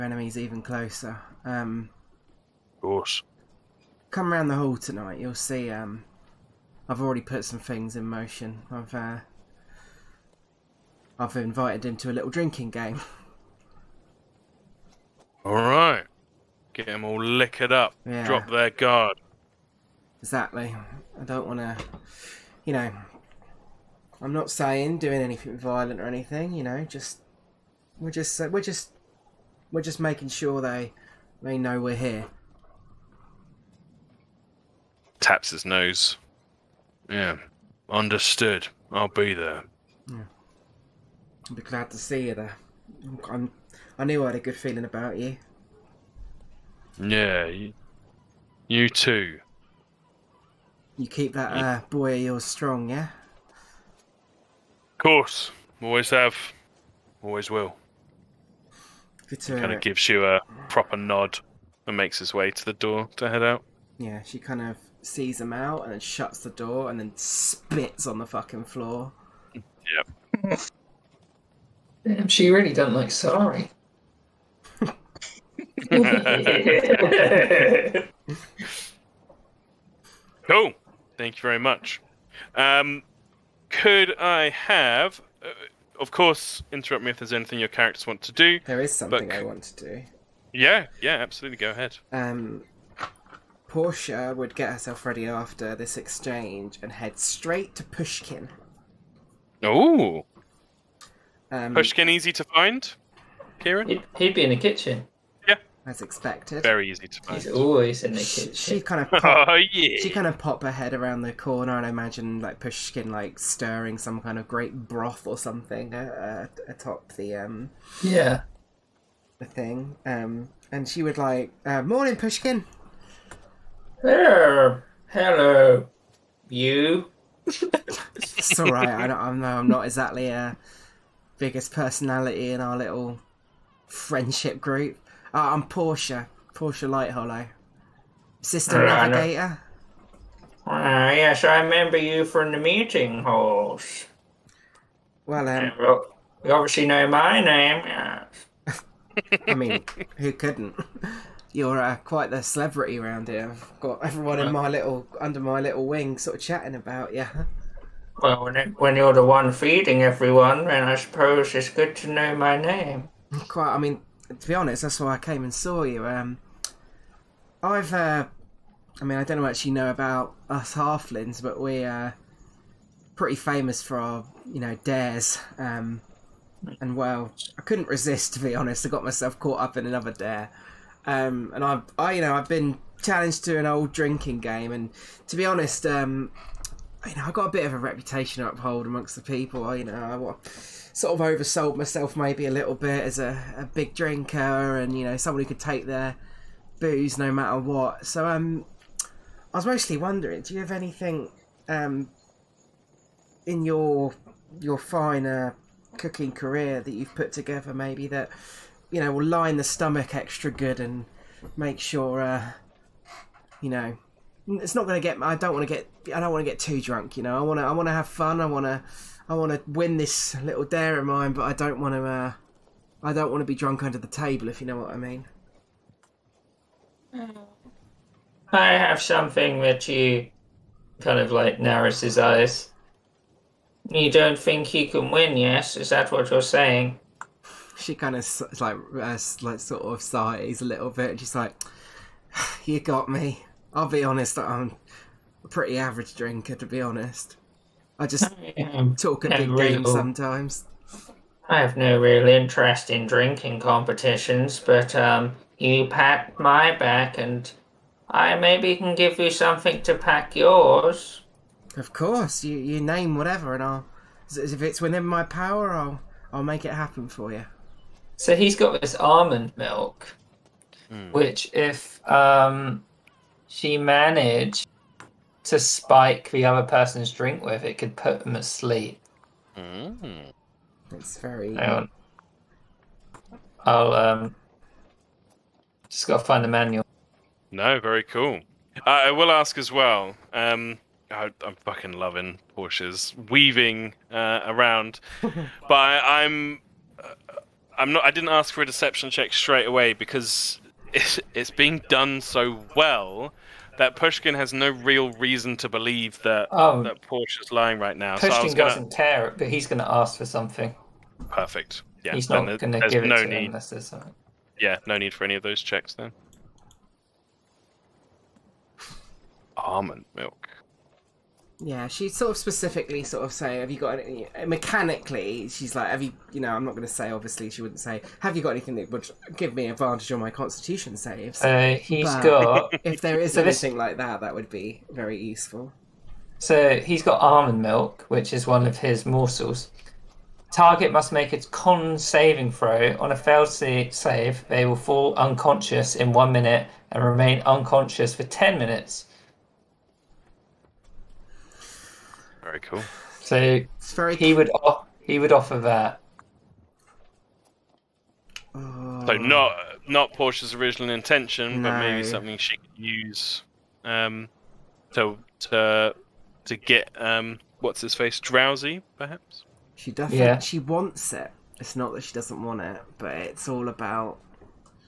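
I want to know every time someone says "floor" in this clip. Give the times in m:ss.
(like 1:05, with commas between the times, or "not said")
1:08.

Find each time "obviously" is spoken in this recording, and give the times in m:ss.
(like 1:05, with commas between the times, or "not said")
2:26, 5:27.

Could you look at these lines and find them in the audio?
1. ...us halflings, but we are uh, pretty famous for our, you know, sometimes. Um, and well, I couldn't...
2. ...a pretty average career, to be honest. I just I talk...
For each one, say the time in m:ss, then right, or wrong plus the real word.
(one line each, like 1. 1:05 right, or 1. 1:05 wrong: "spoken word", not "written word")
1. 2:50 wrong: "dares", not "sometimes"
2. 4:05 wrong: "drinker", not "career".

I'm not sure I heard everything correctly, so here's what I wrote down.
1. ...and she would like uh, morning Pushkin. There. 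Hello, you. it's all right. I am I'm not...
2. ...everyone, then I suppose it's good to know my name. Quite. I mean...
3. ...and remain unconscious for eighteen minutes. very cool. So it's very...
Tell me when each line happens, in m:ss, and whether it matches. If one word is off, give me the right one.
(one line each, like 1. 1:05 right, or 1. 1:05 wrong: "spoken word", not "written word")
1. 2:00 right
2. 2:40 right
3. 5:46 wrong: "ten", not "eighteen".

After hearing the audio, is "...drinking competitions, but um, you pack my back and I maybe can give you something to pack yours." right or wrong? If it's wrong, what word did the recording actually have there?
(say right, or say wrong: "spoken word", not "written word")
right.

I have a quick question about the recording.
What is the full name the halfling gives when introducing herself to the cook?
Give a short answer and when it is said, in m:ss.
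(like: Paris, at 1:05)
Portia Light Hollow, at 2:16.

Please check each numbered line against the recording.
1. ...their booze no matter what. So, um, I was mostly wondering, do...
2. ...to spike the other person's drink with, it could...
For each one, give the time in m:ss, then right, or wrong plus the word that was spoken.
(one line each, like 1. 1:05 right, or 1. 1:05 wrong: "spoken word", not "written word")
1. 3:15 right
2. 4:35 right.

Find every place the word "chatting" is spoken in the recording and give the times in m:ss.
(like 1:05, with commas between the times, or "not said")
2:36.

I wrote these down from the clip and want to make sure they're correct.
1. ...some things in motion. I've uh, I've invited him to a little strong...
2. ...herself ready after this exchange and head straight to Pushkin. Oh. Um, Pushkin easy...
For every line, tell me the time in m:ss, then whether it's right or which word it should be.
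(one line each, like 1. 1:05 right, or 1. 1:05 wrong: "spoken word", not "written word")
1. 0:07 wrong: "drinking", not "strong"
2. 1:34 right.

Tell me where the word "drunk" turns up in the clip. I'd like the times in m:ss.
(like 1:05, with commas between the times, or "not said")
3:36, 3:43.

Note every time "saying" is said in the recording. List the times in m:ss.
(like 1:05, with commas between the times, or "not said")
0:24, 3:56.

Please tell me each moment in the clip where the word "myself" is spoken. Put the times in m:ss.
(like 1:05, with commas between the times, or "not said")
2:59, 3:11.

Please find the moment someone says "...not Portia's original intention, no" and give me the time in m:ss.
5:59.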